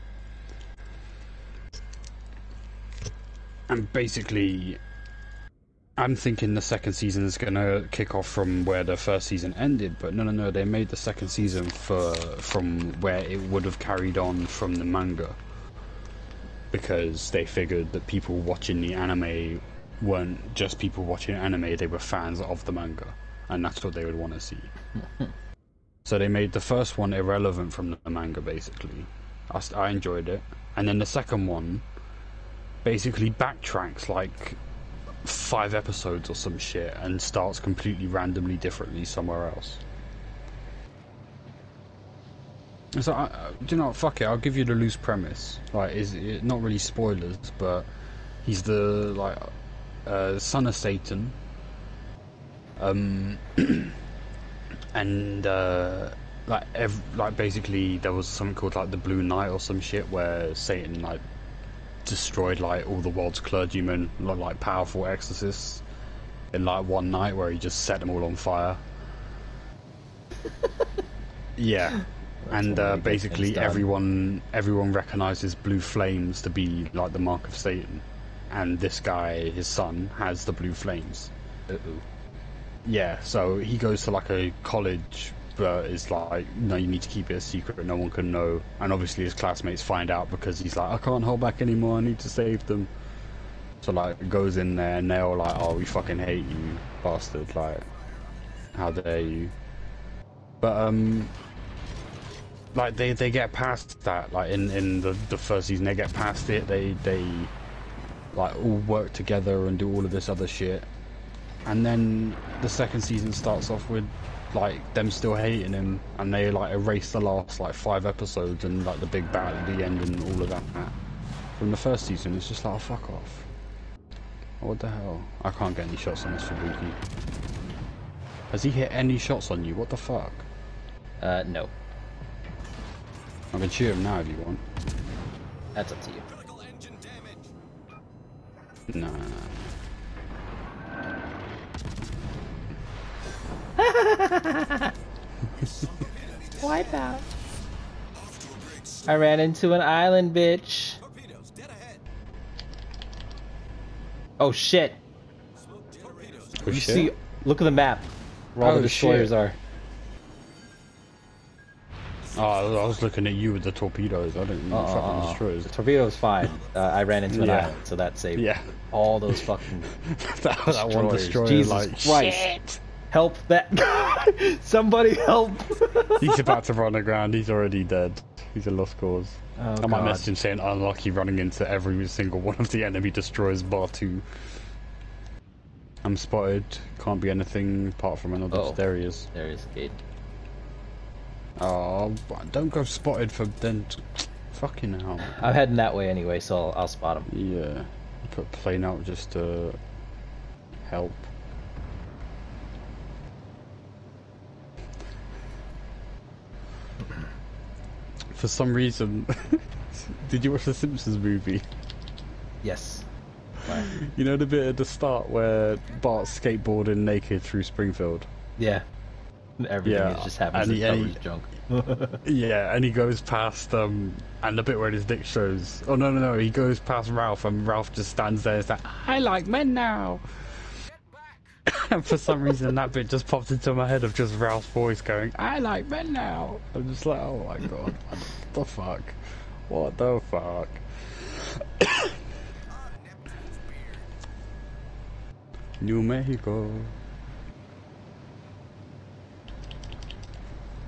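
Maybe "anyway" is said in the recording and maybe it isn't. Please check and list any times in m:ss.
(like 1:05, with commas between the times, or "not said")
3:16.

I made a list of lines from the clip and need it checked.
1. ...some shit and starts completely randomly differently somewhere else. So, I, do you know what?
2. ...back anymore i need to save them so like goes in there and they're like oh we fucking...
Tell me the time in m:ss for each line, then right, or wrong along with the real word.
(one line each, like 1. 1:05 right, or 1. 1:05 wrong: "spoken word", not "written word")
1. 0:36 right
2. 1:31 right.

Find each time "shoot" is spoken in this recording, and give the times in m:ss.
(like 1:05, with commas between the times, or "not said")
2:13.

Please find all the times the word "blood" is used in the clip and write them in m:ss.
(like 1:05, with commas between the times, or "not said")
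not said.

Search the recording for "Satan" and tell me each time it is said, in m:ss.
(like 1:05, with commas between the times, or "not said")
0:50, 1:00, 1:17.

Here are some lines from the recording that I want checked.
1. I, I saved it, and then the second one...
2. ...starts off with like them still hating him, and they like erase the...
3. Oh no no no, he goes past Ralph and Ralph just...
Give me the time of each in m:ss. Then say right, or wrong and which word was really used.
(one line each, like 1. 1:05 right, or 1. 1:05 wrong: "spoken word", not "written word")
1. 0:29 wrong: "enjoyed", not "saved"
2. 1:53 right
3. 3:45 right.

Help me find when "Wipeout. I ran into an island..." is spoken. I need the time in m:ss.
2:26.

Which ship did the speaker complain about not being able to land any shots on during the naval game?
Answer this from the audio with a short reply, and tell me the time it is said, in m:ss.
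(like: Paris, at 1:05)
Fubuki, at 2:06.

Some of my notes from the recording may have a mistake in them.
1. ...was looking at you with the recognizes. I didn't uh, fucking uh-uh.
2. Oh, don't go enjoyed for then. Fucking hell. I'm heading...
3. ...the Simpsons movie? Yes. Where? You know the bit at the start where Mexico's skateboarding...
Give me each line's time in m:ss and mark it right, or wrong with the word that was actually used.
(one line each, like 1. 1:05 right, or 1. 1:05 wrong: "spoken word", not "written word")
1. 2:42 wrong: "torpedoes", not "recognizes"
2. 3:11 wrong: "spotted", not "enjoyed"
3. 3:30 wrong: "Bart", not "Mexico".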